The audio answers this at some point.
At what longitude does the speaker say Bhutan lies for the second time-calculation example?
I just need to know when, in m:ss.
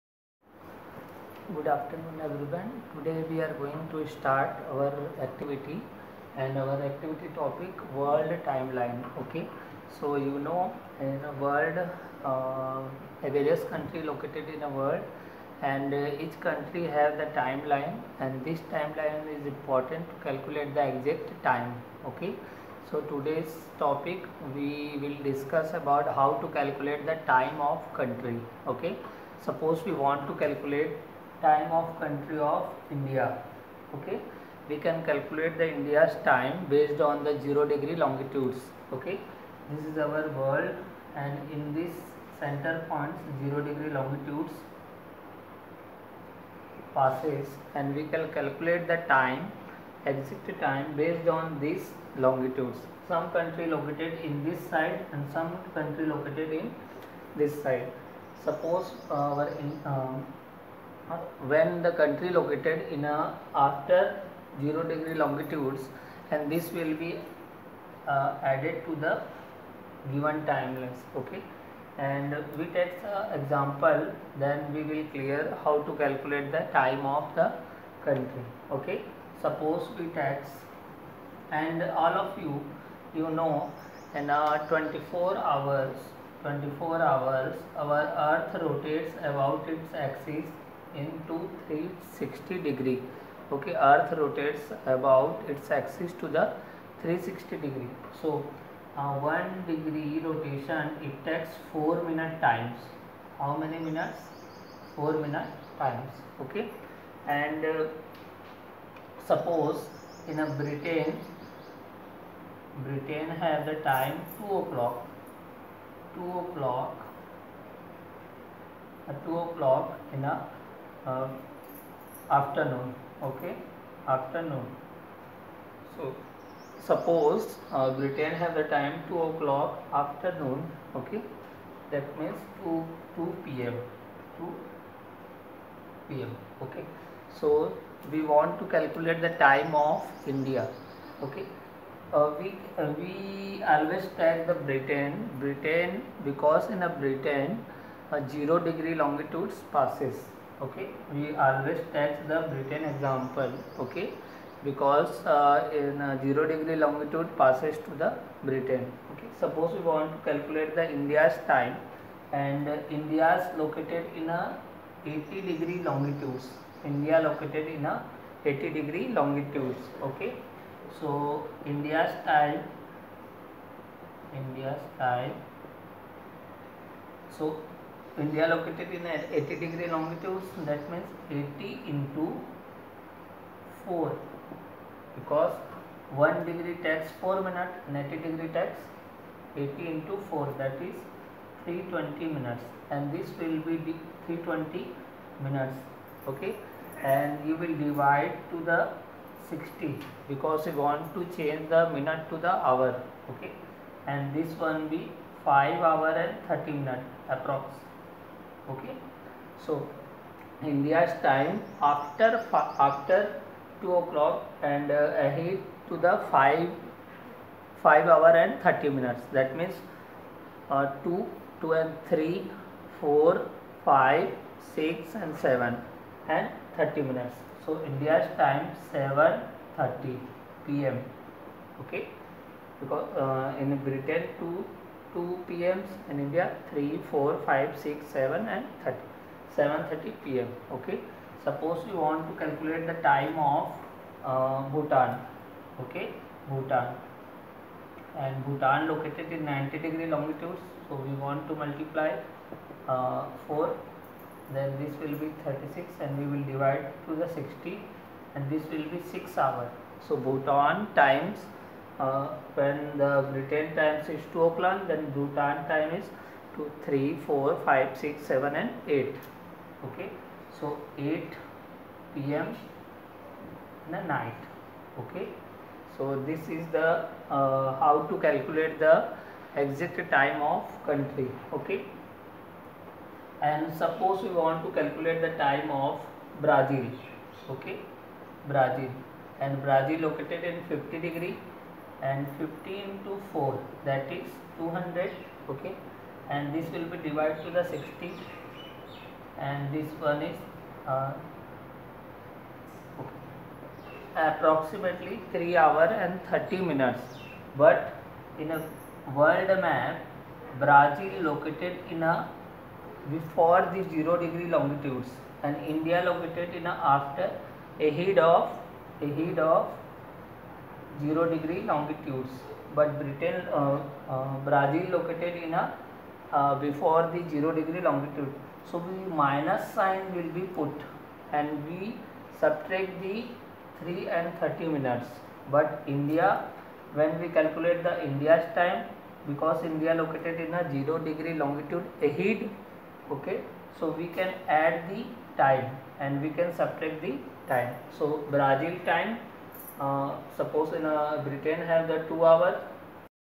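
4:09.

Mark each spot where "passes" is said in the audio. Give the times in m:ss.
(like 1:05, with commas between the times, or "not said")
0:46, 2:29, 2:37.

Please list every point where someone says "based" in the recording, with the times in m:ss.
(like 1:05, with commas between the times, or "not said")
0:36, 0:51.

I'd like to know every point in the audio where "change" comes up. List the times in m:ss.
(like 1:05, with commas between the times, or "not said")
3:21.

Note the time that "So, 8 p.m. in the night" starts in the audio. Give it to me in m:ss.
4:30.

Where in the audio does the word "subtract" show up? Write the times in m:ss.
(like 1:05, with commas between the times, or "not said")
5:32, 5:46.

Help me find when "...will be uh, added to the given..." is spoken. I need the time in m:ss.
1:06.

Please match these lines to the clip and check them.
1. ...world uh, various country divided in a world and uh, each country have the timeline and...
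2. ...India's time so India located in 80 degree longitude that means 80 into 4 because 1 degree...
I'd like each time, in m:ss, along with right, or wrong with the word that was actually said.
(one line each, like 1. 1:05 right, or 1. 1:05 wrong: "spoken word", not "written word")
1. 0:11 wrong: "located", not "divided"
2. 2:54 right.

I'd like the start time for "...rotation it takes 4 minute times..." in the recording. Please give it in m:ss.
1:40.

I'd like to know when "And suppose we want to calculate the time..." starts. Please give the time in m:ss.
4:43.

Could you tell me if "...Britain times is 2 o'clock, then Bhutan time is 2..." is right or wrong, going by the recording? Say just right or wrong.
right.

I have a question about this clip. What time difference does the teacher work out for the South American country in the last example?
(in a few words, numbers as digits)
3 hours 30 minutes.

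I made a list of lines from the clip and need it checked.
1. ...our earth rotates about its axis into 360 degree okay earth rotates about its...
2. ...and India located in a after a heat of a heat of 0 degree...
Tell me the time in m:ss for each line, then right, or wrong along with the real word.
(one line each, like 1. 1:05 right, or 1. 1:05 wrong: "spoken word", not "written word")
1. 1:27 right
2. 5:15 right.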